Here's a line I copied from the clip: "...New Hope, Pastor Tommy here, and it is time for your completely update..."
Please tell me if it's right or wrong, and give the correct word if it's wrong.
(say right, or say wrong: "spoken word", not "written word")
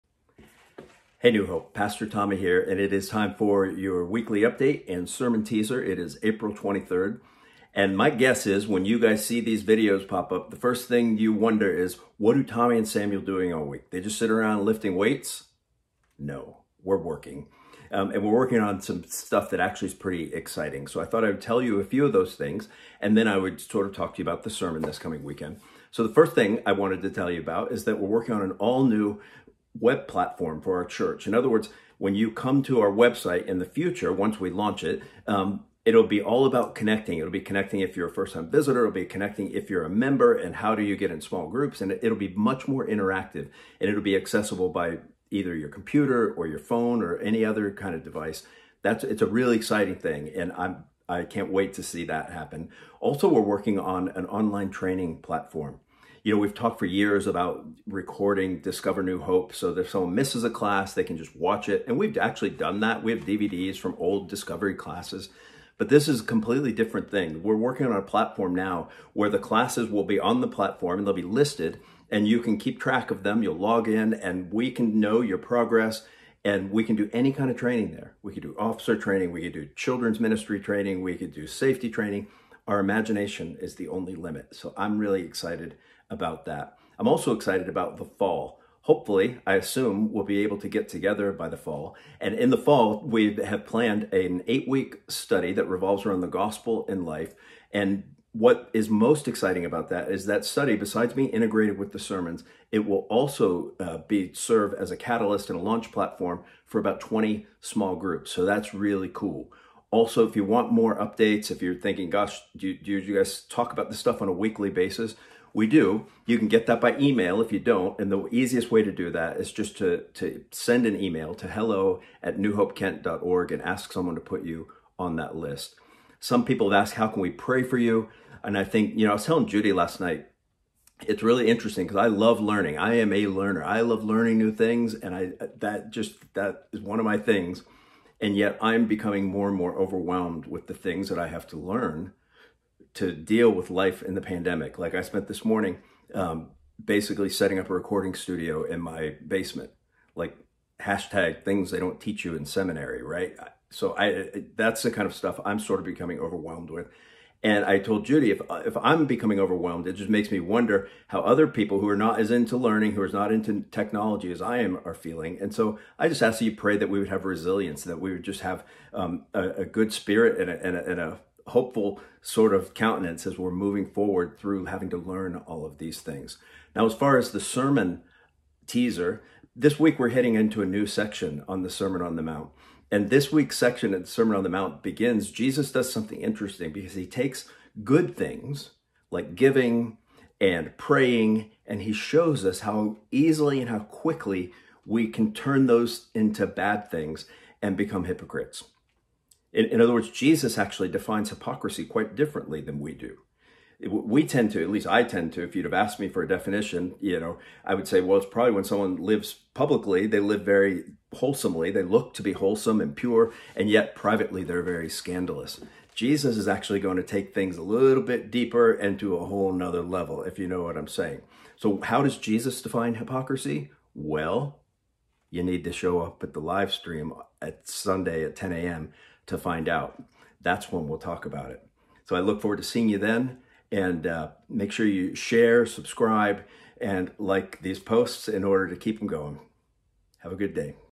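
wrong: "weekly", not "completely".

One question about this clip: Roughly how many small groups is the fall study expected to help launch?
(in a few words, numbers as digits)
20.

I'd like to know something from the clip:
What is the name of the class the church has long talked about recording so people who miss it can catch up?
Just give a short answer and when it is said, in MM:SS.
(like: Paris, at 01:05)
Discover New Hope, at 00:58.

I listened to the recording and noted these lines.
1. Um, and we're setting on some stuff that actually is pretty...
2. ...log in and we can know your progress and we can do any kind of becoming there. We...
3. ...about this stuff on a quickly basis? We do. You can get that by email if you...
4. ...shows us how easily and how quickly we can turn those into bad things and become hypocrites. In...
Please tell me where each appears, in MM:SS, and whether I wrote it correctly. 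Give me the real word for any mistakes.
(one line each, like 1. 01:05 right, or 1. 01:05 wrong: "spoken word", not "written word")
1. 00:17 wrong: "working", not "setting"
2. 01:13 wrong: "training", not "becoming"
3. 01:53 wrong: "weekly", not "quickly"
4. 03:11 right.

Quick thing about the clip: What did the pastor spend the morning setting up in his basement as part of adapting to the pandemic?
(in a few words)
recording studio.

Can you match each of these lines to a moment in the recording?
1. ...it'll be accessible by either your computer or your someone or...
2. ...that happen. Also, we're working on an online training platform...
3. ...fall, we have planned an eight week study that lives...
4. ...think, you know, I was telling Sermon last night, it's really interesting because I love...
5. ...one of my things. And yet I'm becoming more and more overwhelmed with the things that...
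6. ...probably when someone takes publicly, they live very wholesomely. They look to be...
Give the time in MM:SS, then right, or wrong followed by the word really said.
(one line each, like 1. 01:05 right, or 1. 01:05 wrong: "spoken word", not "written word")
1. 00:43 wrong: "phone", not "someone"
2. 00:52 right
3. 01:32 wrong: "revolves", not "lives"
4. 02:08 wrong: "Judy", not "Sermon"
5. 02:16 right
6. 03:28 wrong: "lives", not "takes".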